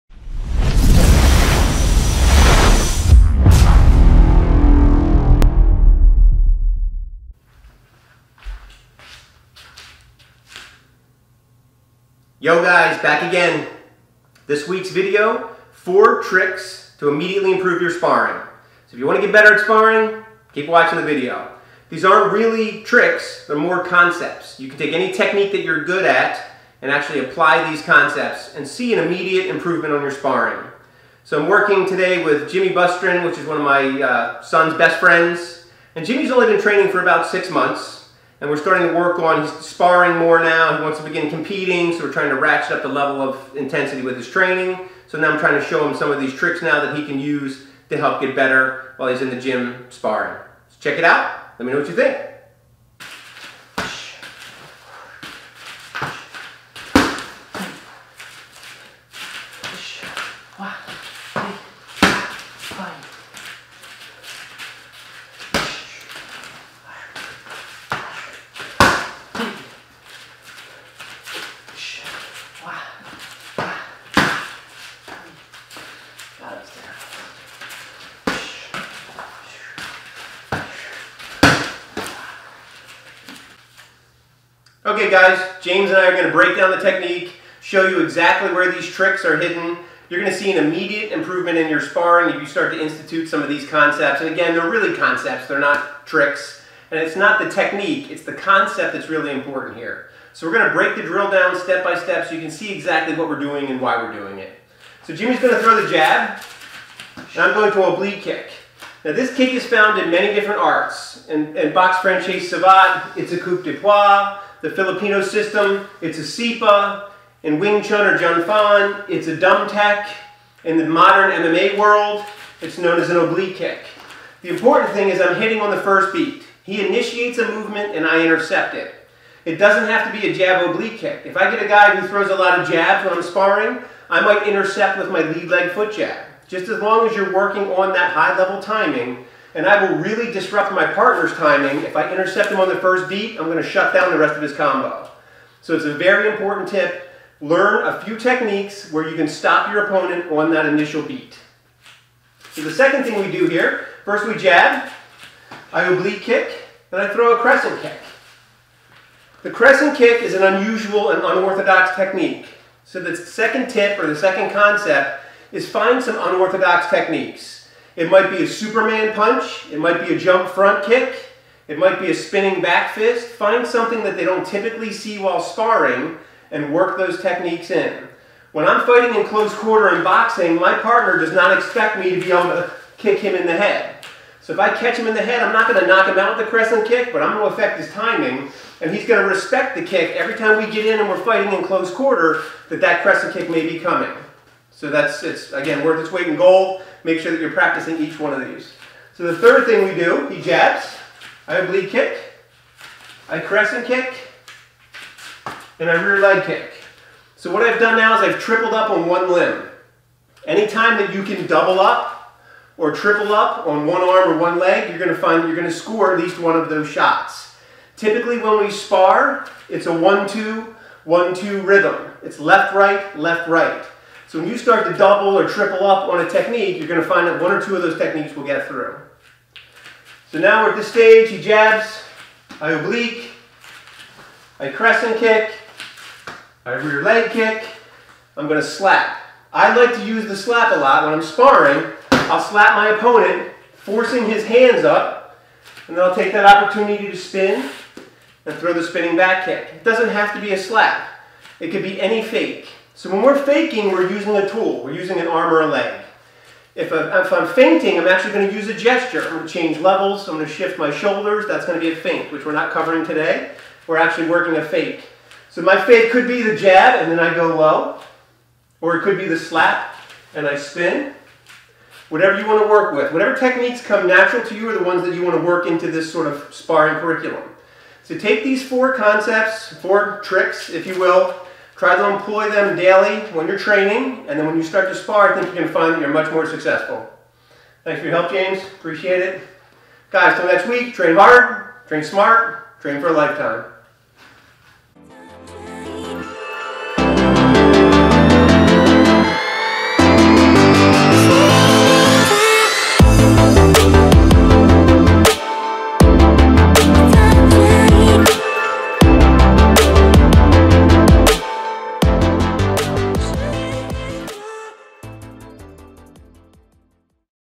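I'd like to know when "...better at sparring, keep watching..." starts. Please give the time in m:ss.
0:19.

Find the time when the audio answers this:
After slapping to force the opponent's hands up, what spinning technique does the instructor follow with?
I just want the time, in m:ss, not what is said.
4:08.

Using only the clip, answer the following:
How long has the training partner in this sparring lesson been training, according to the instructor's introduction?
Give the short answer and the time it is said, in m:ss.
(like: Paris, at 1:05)
6 months, at 0:37.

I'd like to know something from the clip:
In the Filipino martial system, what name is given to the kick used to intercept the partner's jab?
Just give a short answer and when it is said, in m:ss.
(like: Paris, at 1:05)
SIPA, at 1:56.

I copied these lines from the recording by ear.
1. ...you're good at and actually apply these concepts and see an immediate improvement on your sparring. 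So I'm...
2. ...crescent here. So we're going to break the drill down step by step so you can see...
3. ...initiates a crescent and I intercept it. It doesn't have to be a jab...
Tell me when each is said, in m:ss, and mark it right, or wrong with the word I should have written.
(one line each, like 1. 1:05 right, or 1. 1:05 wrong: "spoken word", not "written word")
1. 0:25 right
2. 1:39 wrong: "important", not "crescent"
3. 2:06 wrong: "movement", not "crescent".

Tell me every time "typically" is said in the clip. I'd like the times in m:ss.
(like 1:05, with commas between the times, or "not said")
2:54, 3:37.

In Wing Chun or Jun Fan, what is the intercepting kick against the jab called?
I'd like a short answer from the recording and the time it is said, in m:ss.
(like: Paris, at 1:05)
dum tek, at 1:59.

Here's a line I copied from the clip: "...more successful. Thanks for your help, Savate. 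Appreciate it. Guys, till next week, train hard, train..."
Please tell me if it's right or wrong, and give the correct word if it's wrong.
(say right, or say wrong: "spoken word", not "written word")
wrong: "James", not "Savate".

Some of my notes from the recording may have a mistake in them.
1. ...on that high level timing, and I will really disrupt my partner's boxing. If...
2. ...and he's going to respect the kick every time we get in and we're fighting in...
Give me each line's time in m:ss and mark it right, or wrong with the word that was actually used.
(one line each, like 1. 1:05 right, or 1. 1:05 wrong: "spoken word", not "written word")
1. 2:17 wrong: "timing", not "boxing"
2. 3:08 right.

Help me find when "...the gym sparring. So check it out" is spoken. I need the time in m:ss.
0:49.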